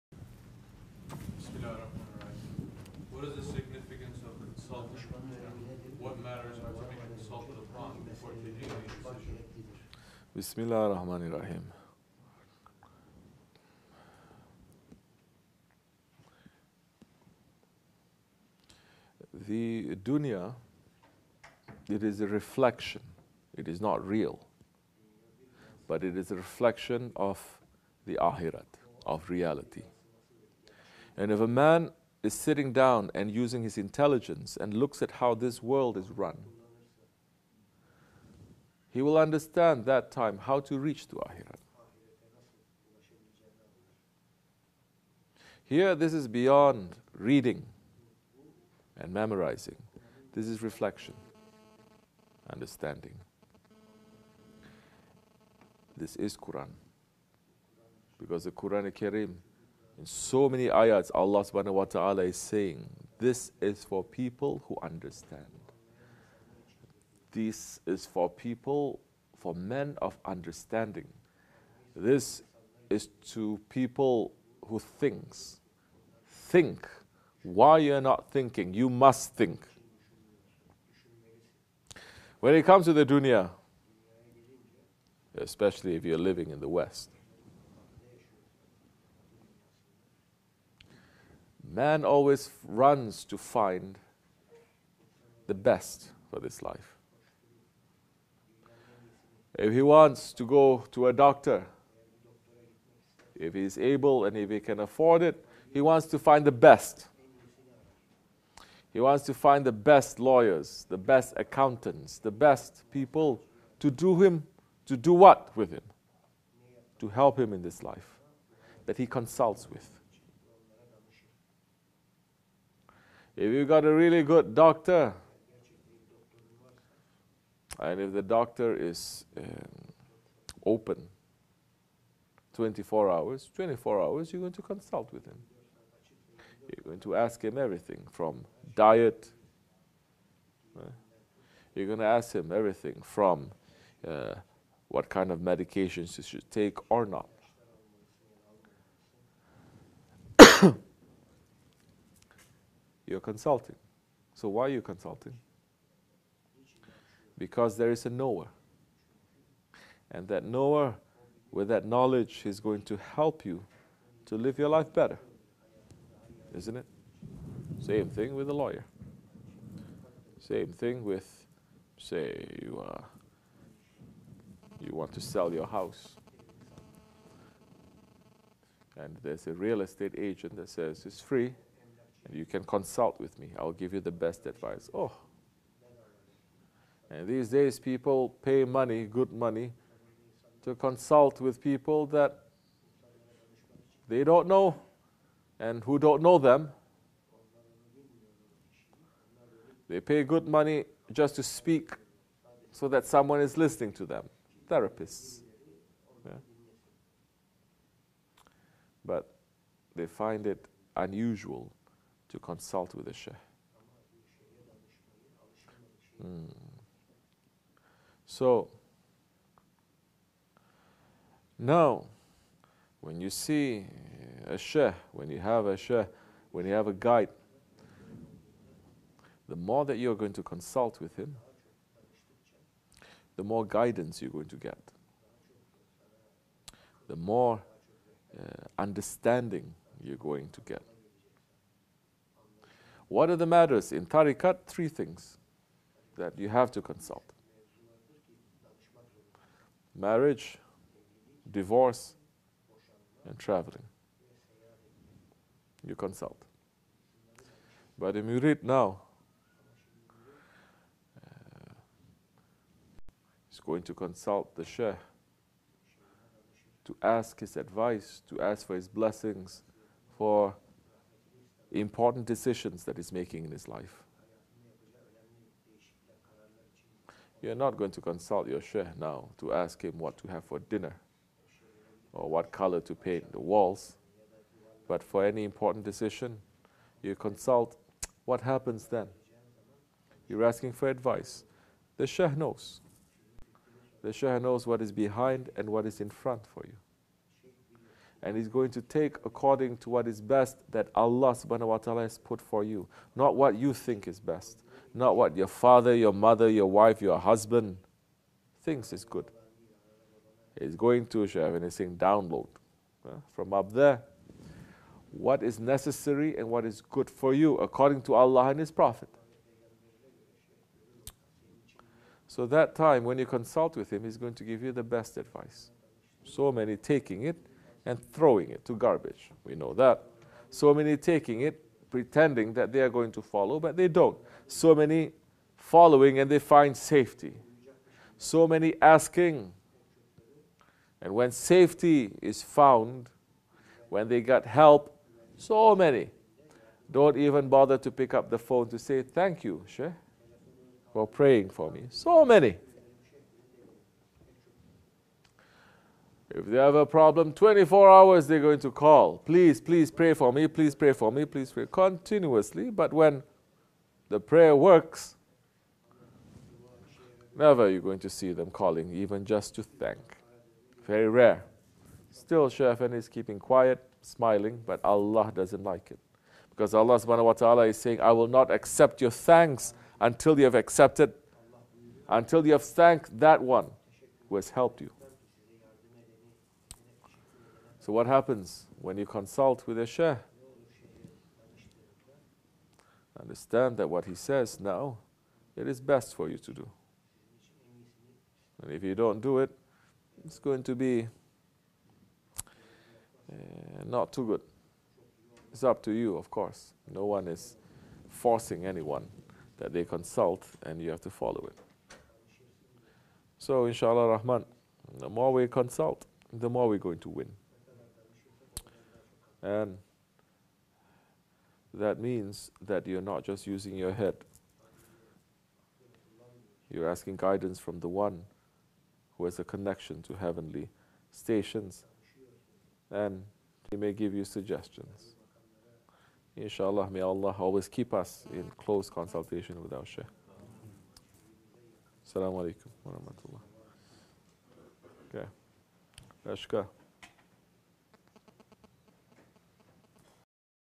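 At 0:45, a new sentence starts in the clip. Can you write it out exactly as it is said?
Here, this is beyond reading and memorizing.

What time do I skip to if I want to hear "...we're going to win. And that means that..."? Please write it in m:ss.
6:56.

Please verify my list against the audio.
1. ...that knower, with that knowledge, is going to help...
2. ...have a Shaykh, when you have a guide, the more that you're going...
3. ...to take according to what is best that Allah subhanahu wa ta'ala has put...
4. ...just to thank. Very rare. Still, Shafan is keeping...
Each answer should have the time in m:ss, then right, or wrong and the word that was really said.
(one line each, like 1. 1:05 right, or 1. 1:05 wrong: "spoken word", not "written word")
1. 2:40 right
2. 3:45 right
3. 4:58 right
4. 6:09 right.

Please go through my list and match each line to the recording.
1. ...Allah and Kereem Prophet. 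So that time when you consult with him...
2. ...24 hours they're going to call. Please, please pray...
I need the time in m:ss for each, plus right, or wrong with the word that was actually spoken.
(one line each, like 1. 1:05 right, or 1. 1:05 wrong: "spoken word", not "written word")
1. 5:18 wrong: "His", not "Kereem"
2. 5:57 right.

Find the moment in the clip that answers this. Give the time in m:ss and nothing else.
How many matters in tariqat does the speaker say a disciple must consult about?
4:04.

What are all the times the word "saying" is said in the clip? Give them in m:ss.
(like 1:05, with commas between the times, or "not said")
1:02, 5:11, 6:17.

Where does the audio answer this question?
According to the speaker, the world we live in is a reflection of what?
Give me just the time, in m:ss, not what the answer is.
0:27.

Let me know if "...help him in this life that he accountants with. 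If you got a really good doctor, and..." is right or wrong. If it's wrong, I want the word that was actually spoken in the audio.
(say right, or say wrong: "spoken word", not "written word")
wrong: "consults", not "accountants".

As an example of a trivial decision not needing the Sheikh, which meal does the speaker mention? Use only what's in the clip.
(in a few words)
dinner.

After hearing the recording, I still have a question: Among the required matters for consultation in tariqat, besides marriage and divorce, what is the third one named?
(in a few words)
traveling.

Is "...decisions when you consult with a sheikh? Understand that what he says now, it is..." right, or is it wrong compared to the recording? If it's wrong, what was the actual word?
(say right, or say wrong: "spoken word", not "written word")
wrong: "happens", not "decisions".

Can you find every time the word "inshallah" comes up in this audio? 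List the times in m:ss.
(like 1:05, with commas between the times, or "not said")
6:53, 7:16.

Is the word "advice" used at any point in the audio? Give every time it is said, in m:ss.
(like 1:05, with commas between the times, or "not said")
3:04, 4:27, 4:50, 5:25.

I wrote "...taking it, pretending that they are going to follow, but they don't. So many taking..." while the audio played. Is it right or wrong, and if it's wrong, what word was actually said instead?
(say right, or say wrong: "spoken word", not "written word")
wrong: "following", not "taking".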